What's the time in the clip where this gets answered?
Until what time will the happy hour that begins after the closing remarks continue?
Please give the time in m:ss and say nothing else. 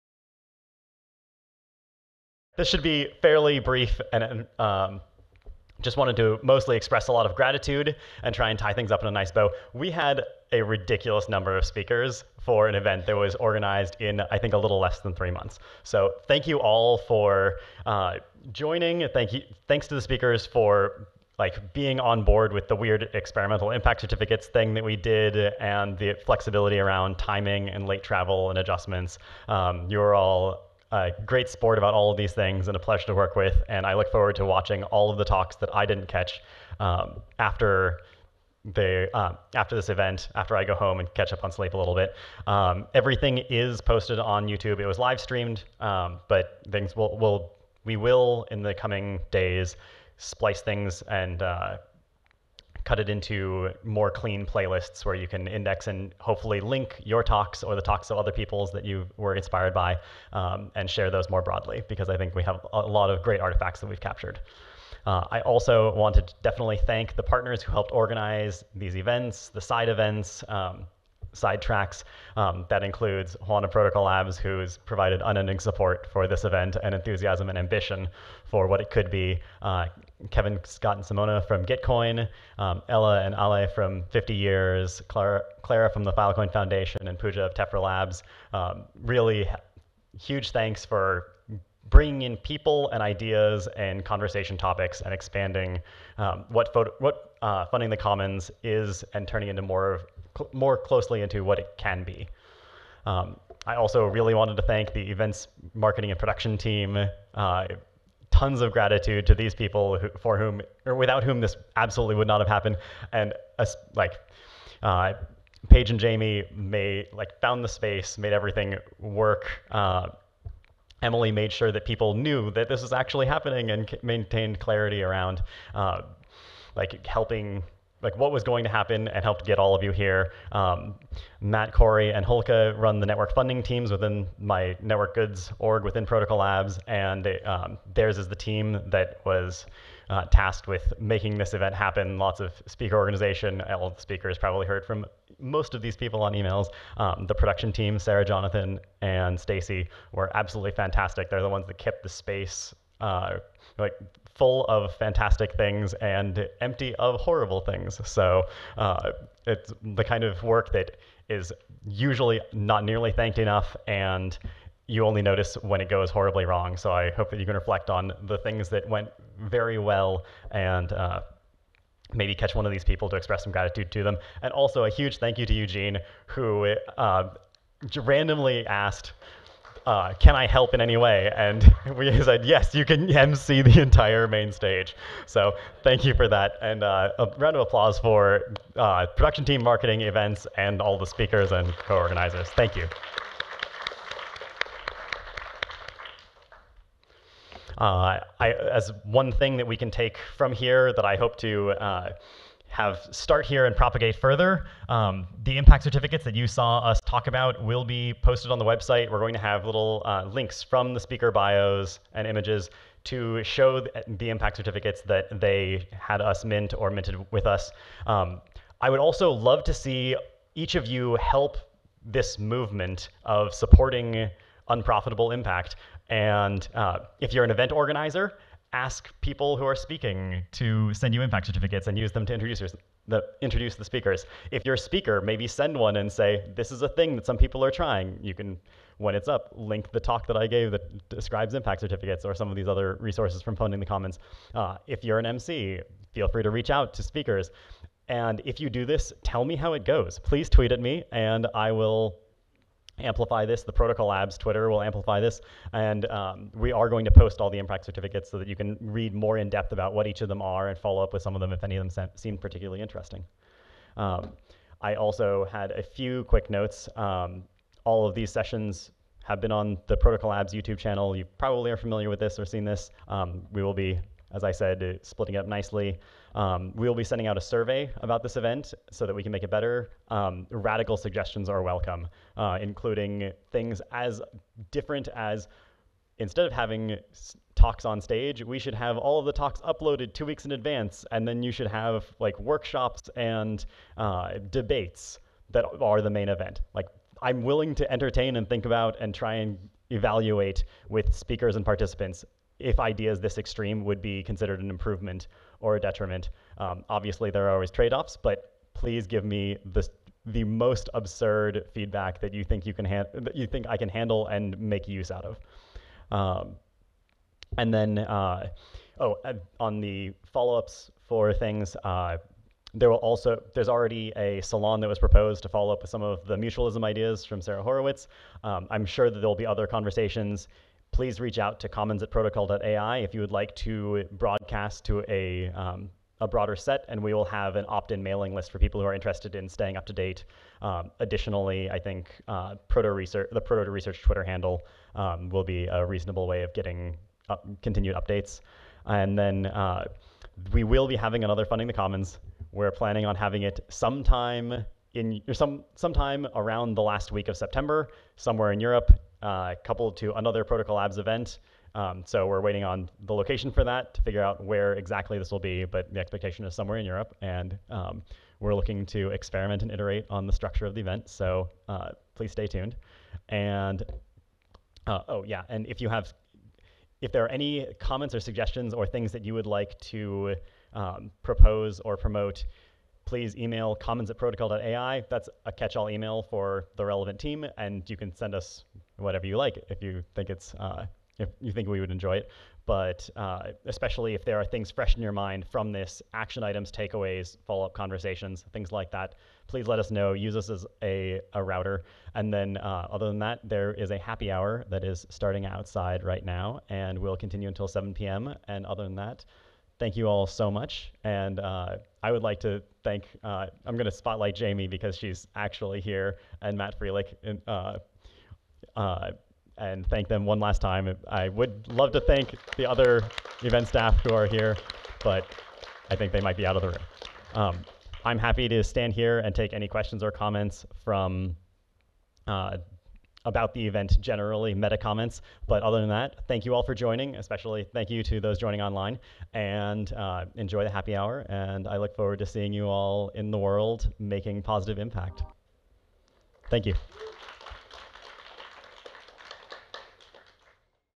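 6:47.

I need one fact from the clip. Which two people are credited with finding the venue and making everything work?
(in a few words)
Paige and Jamie.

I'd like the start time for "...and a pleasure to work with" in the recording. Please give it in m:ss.
0:32.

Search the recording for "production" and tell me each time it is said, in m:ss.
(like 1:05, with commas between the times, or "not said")
1:46, 2:27, 3:09.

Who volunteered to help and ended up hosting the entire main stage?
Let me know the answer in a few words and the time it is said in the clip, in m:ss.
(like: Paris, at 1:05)
Eugene, at 2:55.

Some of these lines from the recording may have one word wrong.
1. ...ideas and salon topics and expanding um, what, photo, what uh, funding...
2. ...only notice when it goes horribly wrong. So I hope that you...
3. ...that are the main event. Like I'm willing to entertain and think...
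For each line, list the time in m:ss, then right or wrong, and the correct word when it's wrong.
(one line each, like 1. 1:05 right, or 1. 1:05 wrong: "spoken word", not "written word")
1. 1:33 wrong: "conversation", not "salon"
2. 2:45 right
3. 4:55 right.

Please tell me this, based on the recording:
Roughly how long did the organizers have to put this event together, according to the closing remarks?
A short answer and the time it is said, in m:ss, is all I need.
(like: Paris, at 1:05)
less than 3 months, at 0:14.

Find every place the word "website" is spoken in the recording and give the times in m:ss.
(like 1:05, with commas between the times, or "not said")
3:28.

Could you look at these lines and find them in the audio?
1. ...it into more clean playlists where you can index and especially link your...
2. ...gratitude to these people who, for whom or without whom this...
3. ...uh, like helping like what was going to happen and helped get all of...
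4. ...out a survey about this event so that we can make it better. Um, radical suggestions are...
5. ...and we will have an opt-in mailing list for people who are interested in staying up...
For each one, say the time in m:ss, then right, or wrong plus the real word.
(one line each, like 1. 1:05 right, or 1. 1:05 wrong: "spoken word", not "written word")
1. 0:52 wrong: "hopefully", not "especially"
2. 1:48 right
3. 2:05 right
4. 4:37 right
5. 5:36 right.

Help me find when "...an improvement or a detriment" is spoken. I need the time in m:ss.
5:04.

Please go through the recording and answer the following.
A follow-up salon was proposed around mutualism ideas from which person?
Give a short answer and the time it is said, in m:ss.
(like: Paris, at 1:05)
Sara Horowitz, at 5:27.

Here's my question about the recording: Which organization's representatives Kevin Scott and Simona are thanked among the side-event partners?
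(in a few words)
Gitcoin.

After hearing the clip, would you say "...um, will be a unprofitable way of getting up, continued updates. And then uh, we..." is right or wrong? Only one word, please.
wrong.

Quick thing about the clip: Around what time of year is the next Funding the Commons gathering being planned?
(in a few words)
last week of September.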